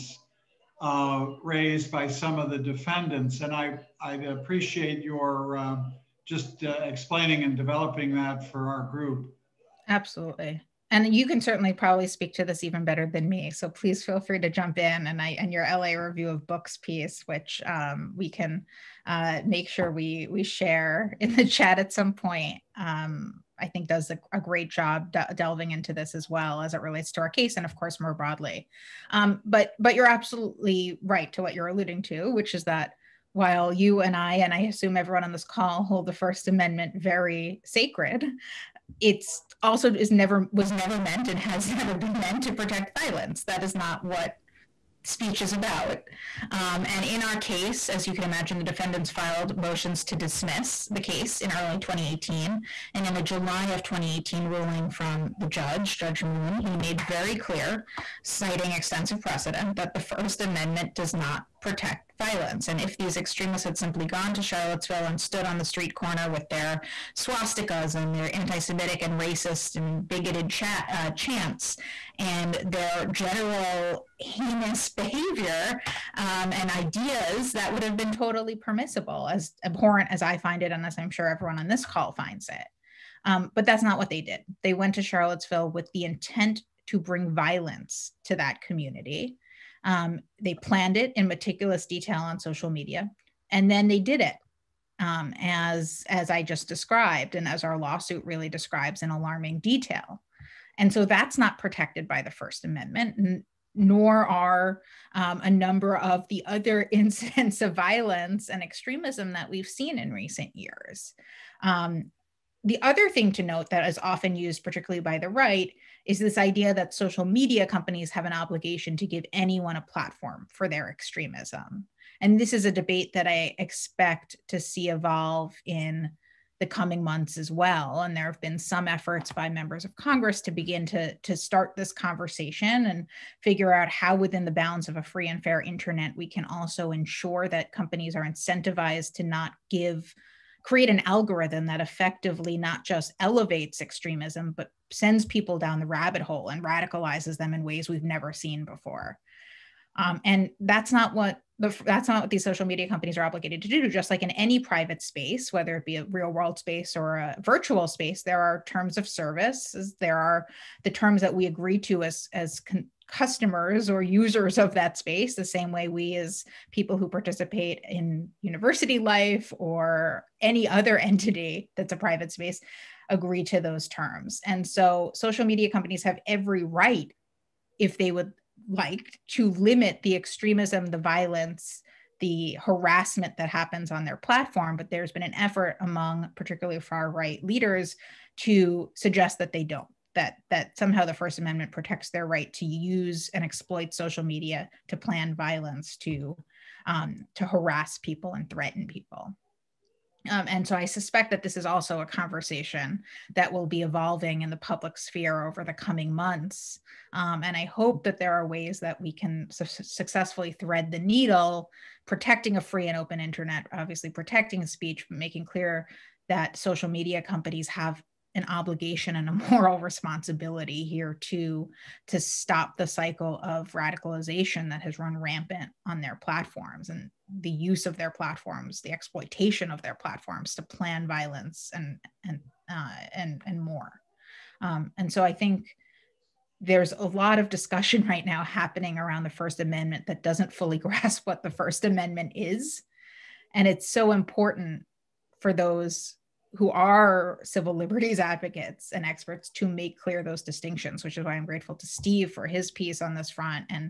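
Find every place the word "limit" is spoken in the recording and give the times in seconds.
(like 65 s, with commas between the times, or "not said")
179 s.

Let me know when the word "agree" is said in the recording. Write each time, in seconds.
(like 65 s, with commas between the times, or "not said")
161 s, 173 s.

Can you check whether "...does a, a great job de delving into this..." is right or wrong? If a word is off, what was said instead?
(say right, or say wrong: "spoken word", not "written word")
right.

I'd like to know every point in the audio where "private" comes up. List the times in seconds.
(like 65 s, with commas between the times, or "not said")
154 s, 171 s.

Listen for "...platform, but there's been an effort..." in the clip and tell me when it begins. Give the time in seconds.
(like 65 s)
184 s.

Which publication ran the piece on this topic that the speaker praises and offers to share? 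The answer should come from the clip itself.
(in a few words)
LA Review of Books.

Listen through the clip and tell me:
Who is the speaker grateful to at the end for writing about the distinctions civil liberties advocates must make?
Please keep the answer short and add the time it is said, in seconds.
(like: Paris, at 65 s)
Steve, at 251 s.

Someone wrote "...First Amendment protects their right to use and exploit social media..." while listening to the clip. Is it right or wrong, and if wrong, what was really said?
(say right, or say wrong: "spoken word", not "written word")
right.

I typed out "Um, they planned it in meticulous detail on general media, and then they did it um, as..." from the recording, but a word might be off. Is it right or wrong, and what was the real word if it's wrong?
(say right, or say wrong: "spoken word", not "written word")
wrong: "social", not "general".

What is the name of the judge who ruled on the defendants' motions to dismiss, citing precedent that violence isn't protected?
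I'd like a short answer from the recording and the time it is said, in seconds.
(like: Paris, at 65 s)
Judge Moon, at 55 s.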